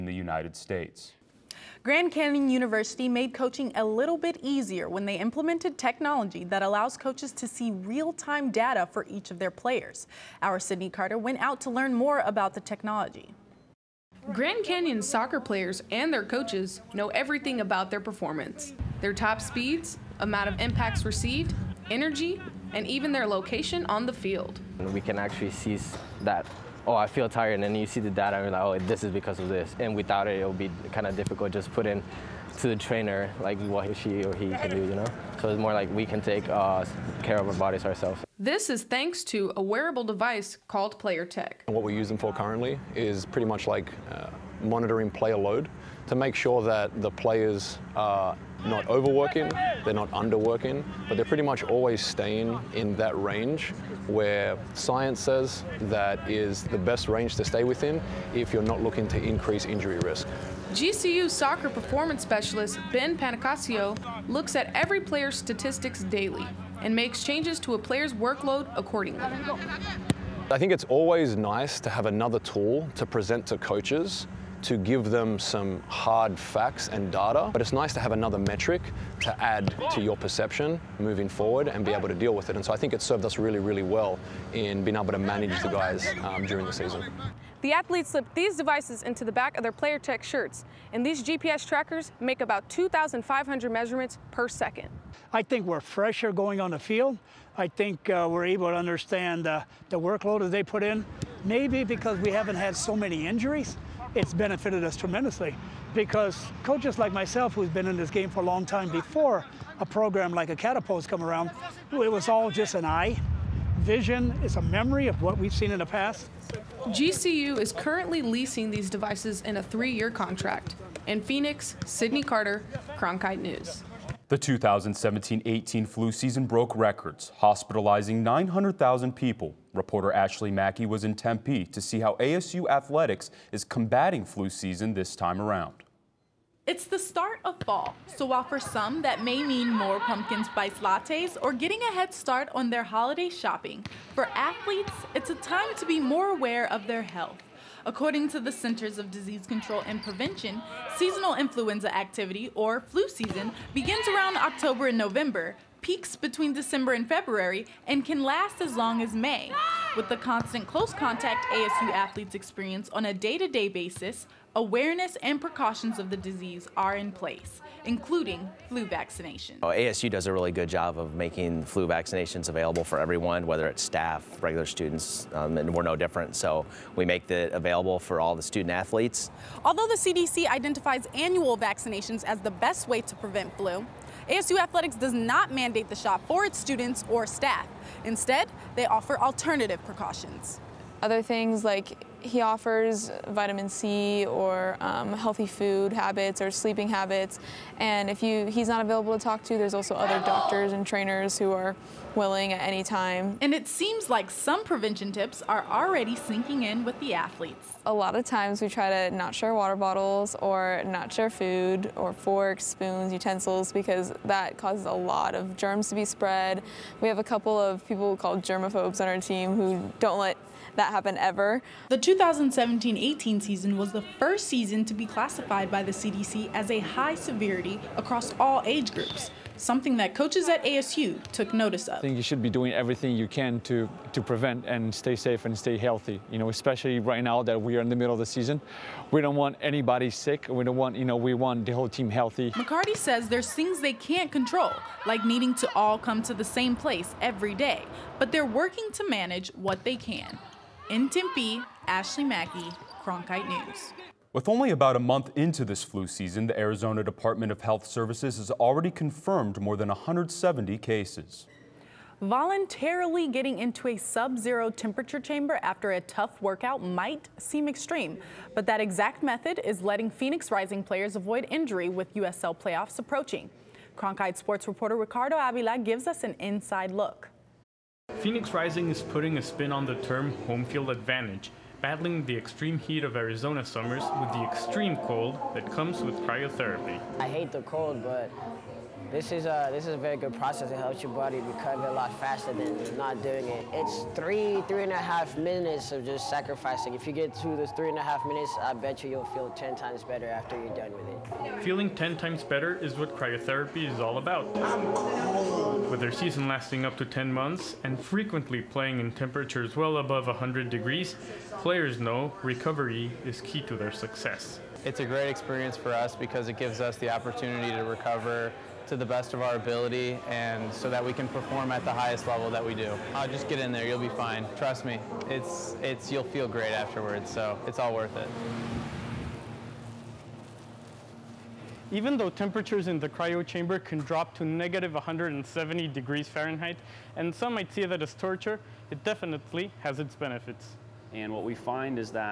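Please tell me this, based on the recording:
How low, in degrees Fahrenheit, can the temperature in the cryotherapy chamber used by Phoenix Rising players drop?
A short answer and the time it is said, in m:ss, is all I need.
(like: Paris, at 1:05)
-170, at 5:34.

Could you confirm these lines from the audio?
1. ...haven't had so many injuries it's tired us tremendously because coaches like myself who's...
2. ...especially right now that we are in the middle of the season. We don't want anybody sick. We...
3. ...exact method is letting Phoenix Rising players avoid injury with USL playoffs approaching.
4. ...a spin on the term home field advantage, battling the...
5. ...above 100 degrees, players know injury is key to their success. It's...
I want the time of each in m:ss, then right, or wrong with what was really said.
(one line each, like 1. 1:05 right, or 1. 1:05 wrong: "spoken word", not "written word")
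1. 1:42 wrong: "benefited", not "tired"
2. 3:56 right
3. 4:28 right
4. 4:39 right
5. 5:09 wrong: "recovery", not "injury".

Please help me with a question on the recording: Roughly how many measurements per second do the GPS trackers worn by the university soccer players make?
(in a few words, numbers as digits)
2,500.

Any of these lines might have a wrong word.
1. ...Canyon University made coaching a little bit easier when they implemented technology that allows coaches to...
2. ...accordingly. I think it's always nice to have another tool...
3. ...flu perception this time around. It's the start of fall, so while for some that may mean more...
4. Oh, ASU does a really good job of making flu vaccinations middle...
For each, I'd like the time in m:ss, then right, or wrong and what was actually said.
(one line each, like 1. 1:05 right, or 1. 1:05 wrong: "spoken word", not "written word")
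1. 0:02 right
2. 1:08 right
3. 2:14 wrong: "season", not "perception"
4. 2:49 wrong: "available", not "middle".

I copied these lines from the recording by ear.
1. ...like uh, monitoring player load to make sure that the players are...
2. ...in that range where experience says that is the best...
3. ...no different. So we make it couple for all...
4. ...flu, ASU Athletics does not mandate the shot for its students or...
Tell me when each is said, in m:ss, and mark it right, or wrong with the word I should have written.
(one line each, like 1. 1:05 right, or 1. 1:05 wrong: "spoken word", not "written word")
1. 0:43 right
2. 0:52 wrong: "science", not "experience"
3. 2:55 wrong: "available", not "couple"
4. 3:03 right.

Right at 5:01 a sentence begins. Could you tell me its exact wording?
Feeling ten times better is what cryotherapy is all about.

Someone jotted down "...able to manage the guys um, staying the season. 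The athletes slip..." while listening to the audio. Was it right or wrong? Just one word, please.
wrong.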